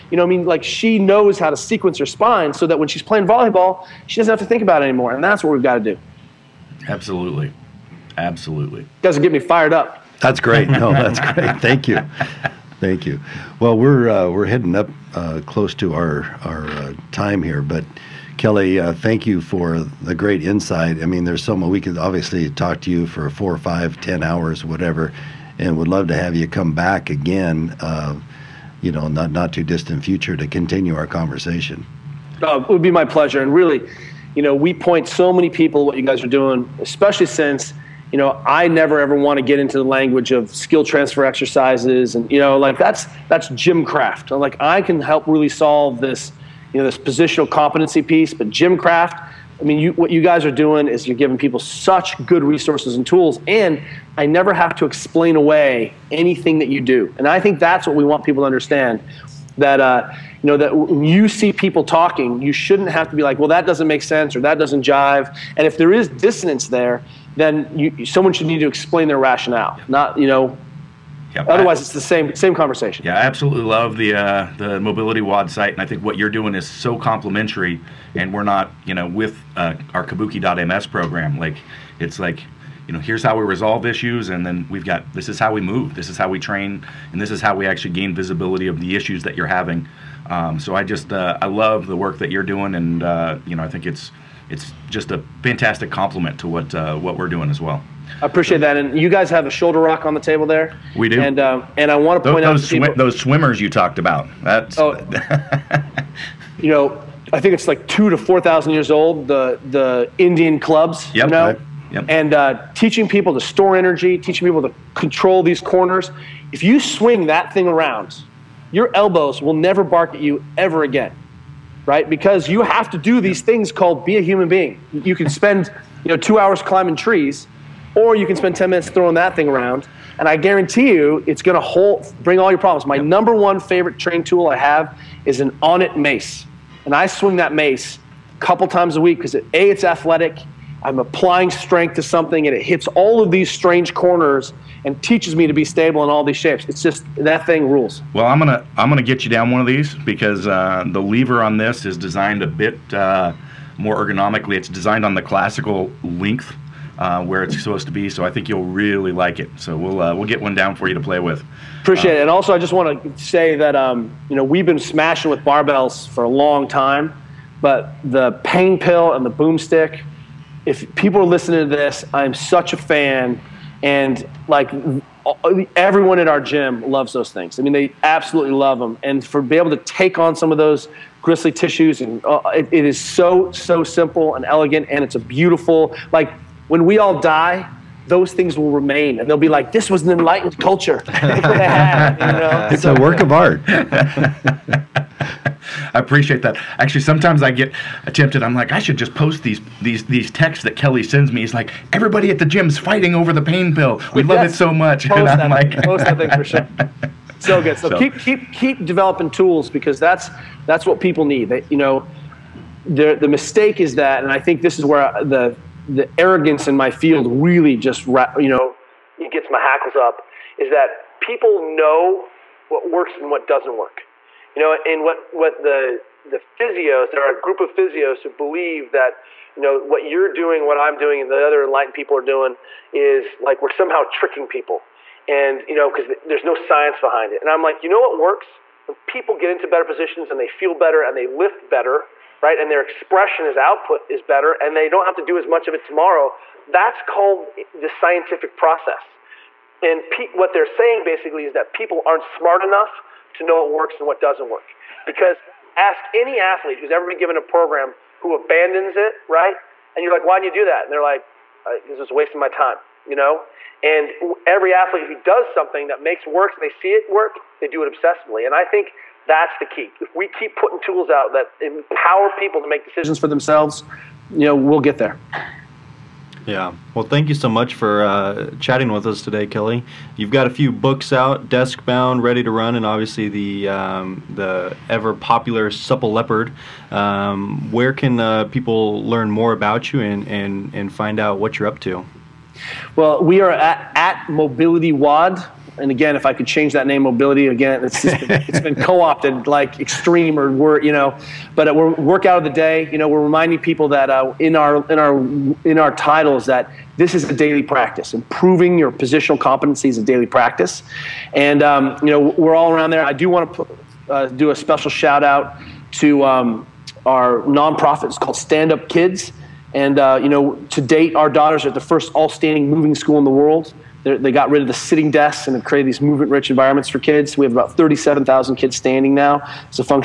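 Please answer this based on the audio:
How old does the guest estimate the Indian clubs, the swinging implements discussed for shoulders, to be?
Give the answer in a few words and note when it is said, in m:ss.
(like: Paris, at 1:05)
2 to 4 thousand years, at 1:47.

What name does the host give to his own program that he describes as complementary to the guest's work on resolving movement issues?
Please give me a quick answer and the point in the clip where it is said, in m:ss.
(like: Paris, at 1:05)
Kabuki.ms, at 1:20.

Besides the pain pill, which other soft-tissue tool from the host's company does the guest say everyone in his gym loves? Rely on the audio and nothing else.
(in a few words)
the boomstick.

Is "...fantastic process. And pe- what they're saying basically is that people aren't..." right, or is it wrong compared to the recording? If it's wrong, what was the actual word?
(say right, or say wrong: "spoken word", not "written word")
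wrong: "scientific", not "fantastic".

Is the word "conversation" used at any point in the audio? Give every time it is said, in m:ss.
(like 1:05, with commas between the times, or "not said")
0:31, 1:12.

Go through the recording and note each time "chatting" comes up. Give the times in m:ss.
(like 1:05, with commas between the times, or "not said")
4:38.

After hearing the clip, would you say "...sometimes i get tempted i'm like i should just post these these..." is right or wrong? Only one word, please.
right.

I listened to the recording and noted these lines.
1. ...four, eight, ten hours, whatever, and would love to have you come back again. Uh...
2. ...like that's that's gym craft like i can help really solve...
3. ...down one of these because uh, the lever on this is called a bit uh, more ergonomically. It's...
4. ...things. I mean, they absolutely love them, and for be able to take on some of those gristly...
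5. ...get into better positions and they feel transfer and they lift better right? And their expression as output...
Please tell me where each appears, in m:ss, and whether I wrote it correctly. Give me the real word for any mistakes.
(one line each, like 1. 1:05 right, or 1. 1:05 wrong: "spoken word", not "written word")
1. 0:23 wrong: "five", not "eight"
2. 0:42 right
3. 2:29 wrong: "designed", not "called"
4. 2:57 right
5. 3:59 wrong: "better", not "transfer".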